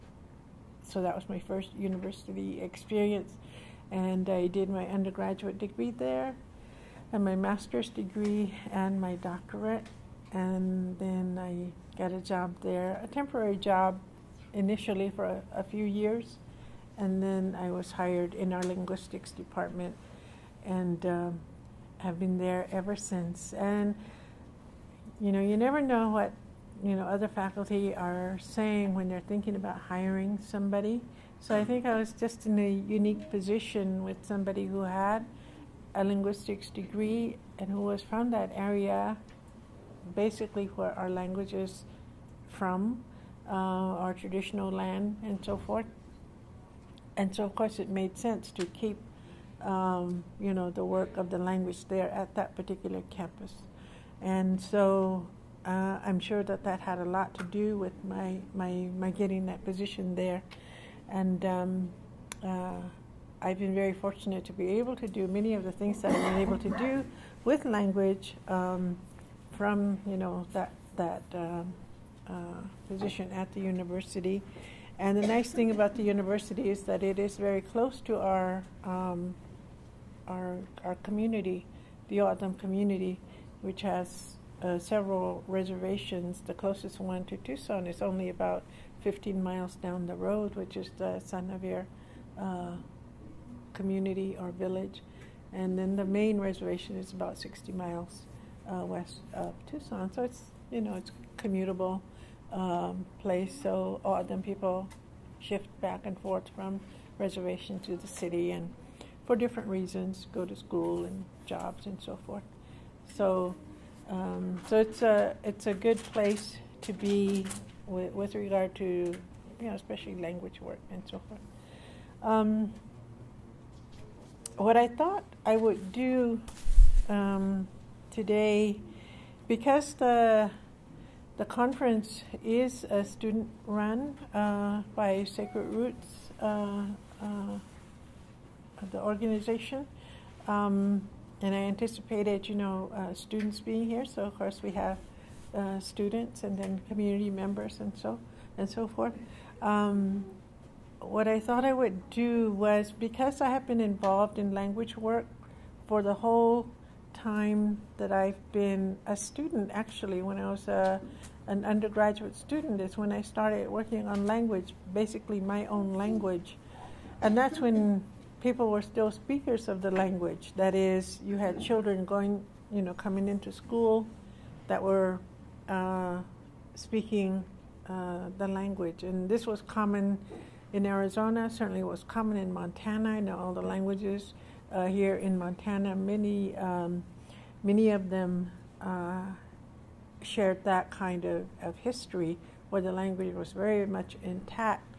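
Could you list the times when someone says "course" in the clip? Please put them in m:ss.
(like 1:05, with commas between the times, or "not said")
0:47, 2:24.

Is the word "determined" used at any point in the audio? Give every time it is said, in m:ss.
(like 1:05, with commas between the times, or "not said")
not said.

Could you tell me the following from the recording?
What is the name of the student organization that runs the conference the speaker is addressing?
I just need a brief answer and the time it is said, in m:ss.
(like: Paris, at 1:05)
Sacred Roots, at 2:15.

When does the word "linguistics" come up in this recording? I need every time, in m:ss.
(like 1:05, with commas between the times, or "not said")
0:18, 0:36.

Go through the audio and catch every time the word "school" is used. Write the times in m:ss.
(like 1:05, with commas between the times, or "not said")
1:50, 2:53.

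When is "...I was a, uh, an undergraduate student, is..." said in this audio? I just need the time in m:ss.
2:40.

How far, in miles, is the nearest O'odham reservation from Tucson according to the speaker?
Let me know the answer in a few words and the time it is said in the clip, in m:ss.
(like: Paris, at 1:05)
15, at 1:29.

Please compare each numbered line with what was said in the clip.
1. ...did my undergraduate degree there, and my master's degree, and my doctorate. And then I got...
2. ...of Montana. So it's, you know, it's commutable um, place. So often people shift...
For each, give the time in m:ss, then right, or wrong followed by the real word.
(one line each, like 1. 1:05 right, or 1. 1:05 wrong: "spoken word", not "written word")
1. 0:04 right
2. 1:39 wrong: "Tucson", not "Montana".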